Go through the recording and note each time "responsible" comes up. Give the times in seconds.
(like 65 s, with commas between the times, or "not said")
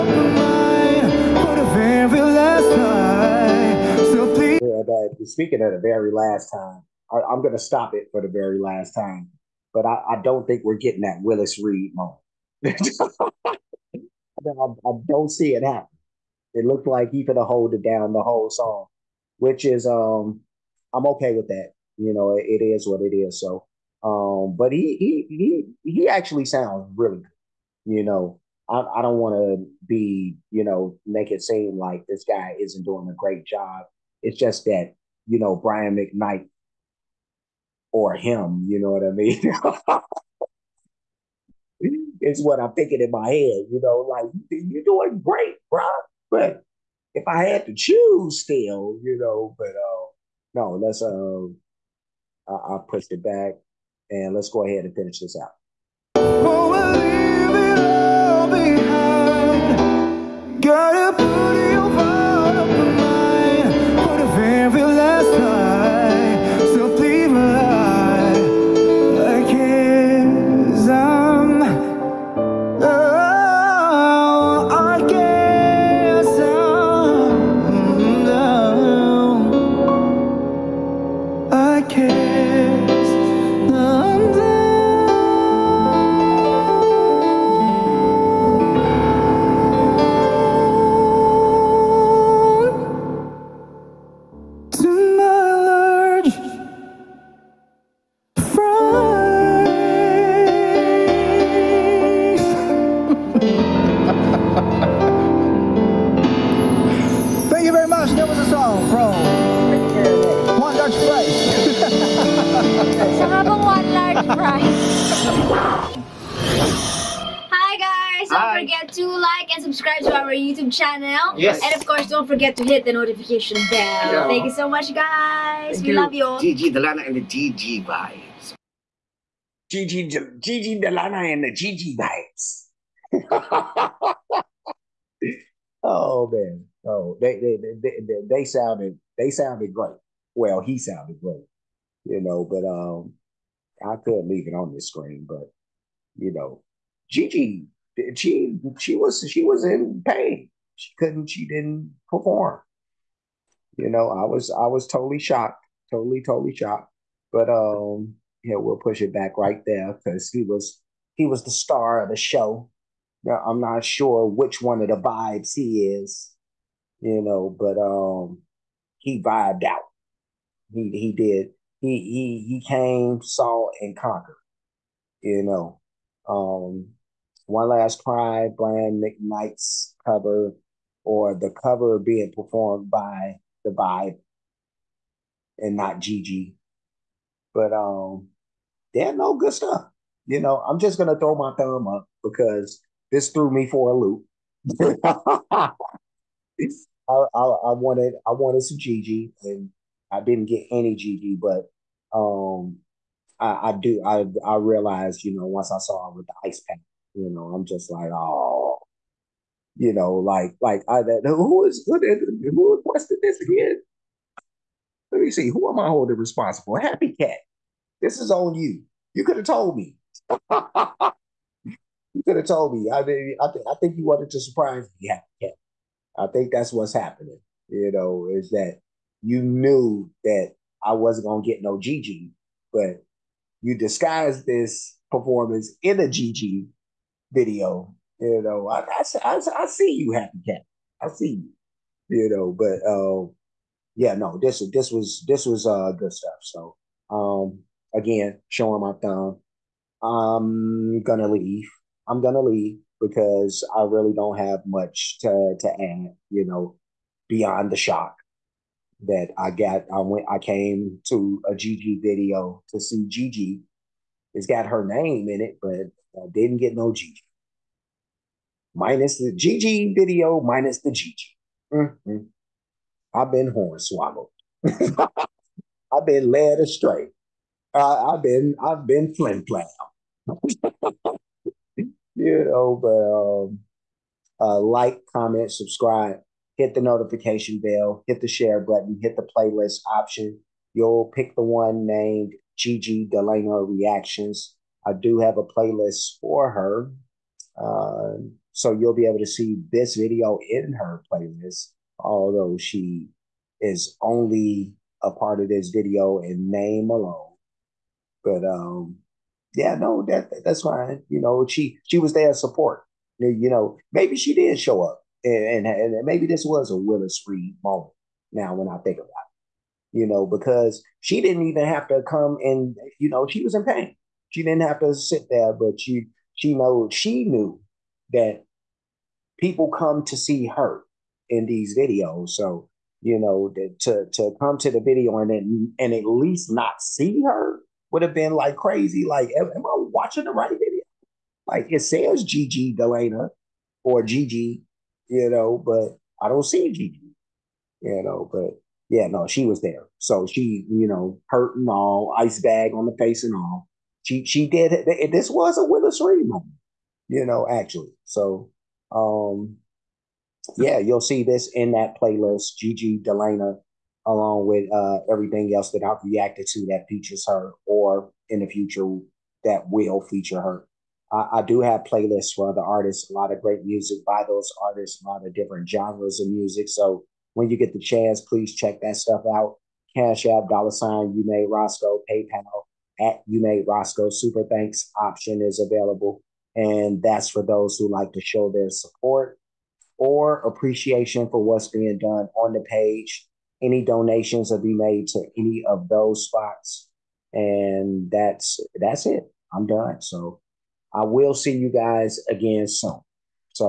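216 s.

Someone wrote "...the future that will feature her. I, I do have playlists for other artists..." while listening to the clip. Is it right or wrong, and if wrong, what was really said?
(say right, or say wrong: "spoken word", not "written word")
right.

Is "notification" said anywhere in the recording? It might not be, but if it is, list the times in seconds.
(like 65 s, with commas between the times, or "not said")
122 s, 286 s.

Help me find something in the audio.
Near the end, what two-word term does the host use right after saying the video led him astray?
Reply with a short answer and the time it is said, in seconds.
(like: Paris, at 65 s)
flim flam, at 279 s.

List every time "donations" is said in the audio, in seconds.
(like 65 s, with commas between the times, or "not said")
393 s.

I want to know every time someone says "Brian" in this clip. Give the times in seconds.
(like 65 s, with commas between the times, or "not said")
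35 s, 178 s.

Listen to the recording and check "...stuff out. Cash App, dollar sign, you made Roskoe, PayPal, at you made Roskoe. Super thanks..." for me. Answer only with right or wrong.
right.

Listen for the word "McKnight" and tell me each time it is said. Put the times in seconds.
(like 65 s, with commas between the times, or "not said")
35 s, 179 s.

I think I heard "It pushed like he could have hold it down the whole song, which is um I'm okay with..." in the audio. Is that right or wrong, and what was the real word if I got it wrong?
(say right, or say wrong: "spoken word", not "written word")
wrong: "looked", not "pushed".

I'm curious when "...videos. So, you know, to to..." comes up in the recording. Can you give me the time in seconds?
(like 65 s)
331 s.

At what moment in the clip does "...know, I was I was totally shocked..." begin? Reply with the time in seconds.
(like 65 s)
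153 s.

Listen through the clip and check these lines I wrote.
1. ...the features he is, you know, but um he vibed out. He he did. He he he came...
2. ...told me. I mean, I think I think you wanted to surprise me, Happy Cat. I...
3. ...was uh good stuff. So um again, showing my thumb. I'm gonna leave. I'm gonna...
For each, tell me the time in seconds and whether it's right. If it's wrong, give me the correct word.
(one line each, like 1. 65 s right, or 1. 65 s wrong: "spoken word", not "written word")
1. 164 s wrong: "vibes", not "features"
2. 222 s right
3. 245 s right.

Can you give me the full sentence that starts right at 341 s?
Like it says Gigi Galena or Gigi, you know, but I don't see Gigi, you know, but yeah, no, she was there.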